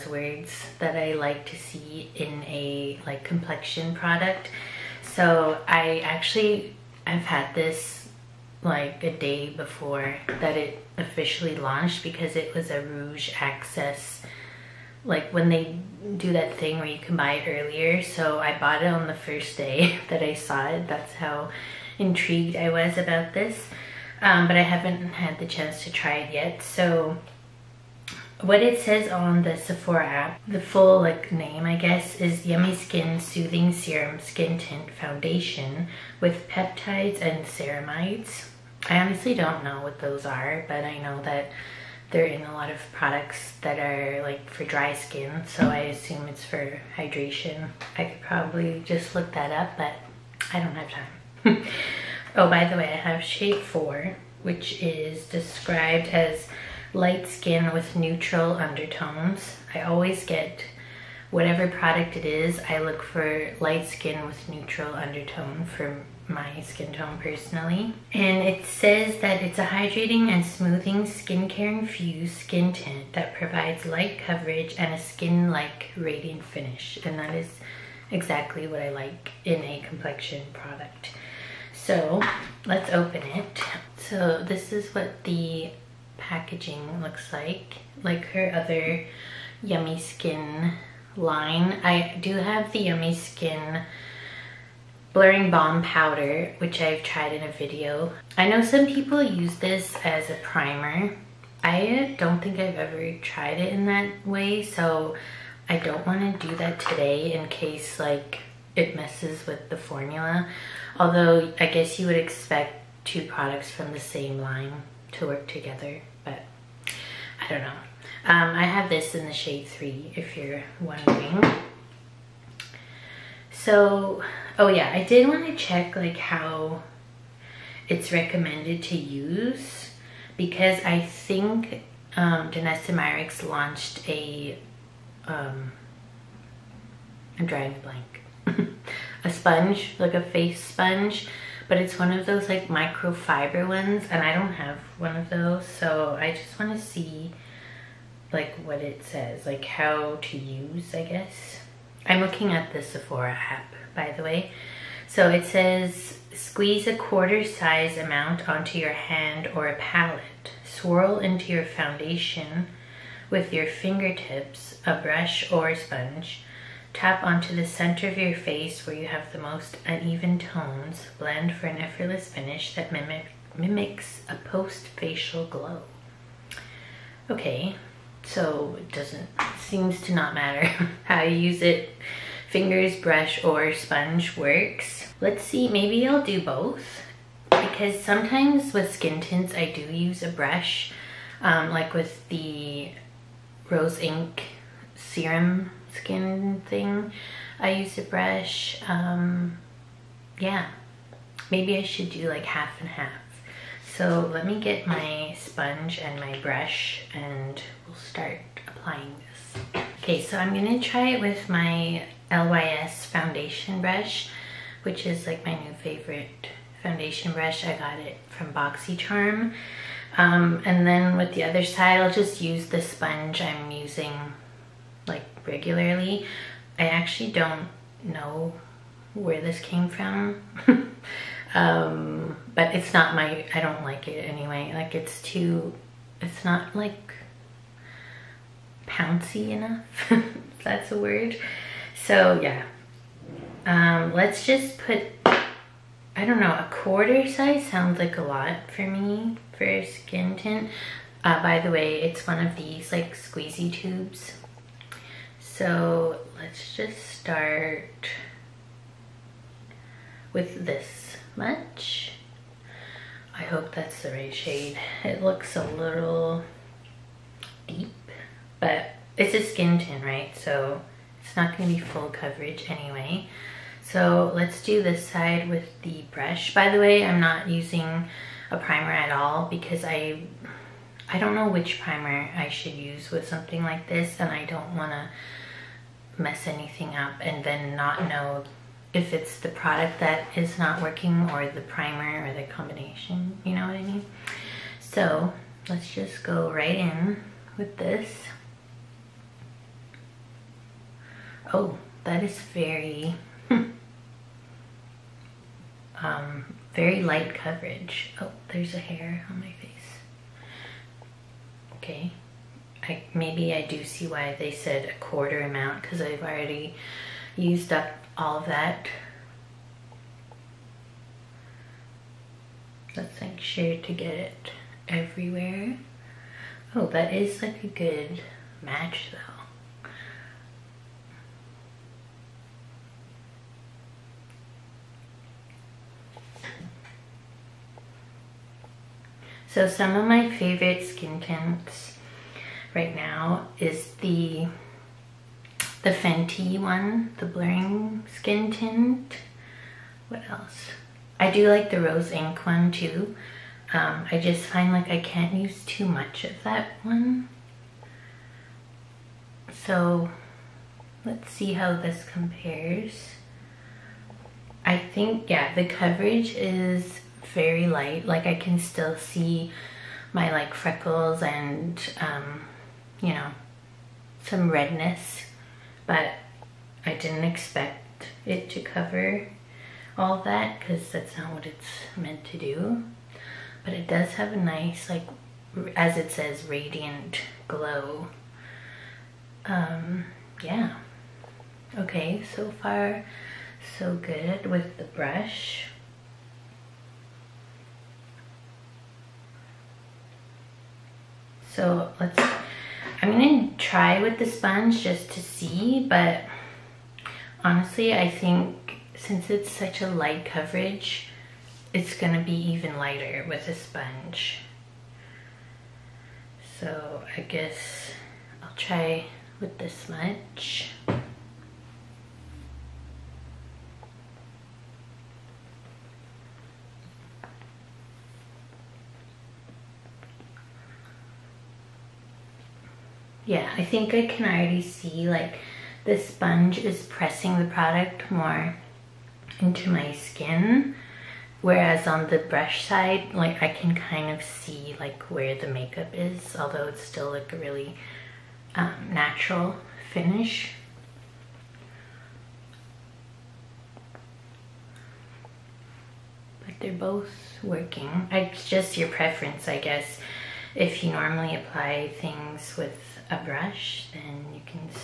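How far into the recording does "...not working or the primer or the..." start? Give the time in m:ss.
4:50.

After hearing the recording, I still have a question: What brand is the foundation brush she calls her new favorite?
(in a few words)
LYS.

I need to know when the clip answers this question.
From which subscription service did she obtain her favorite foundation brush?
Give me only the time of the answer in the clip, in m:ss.
3:38.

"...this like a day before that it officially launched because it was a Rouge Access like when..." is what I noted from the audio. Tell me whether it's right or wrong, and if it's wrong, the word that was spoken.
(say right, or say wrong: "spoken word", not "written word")
right.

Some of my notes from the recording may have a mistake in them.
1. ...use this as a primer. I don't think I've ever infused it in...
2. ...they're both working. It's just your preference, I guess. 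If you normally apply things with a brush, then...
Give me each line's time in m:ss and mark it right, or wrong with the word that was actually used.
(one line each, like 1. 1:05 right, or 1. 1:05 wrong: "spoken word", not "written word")
1. 1:39 wrong: "tried", not "infused"
2. 7:36 right.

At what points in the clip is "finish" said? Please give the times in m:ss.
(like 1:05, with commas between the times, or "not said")
1:16, 2:52, 7:29.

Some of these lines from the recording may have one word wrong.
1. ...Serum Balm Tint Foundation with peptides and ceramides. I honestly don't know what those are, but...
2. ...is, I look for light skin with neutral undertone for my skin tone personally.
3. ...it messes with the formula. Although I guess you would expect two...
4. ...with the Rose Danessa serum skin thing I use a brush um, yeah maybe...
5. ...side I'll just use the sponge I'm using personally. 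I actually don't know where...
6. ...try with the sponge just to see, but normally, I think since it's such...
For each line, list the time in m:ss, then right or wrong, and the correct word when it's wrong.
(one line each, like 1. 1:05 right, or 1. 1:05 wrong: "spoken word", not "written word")
1. 0:33 wrong: "Skin", not "Balm"
2. 1:02 right
3. 1:48 right
4. 3:11 wrong: "Inc", not "Danessa"
5. 3:41 wrong: "regularly", not "personally"
6. 6:43 wrong: "honestly", not "normally".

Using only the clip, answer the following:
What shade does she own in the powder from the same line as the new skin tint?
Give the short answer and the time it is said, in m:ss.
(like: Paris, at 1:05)
3, at 1:59.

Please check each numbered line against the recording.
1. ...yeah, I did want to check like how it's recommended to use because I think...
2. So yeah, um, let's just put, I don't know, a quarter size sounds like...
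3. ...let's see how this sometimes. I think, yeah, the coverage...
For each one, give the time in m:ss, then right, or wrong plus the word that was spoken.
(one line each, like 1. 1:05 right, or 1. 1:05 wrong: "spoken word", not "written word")
1. 2:04 right
2. 4:02 right
3. 6:01 wrong: "compares", not "sometimes".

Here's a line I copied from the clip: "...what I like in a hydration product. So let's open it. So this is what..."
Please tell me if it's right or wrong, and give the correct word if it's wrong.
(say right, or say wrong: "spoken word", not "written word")
wrong: "complexion", not "hydration".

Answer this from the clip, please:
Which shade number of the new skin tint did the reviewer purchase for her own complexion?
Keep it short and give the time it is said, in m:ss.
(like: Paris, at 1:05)
4, at 0:53.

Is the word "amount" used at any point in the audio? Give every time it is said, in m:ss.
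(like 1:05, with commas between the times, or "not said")
2:37, 5:15.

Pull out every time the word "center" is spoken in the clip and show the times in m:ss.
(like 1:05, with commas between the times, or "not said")
2:47.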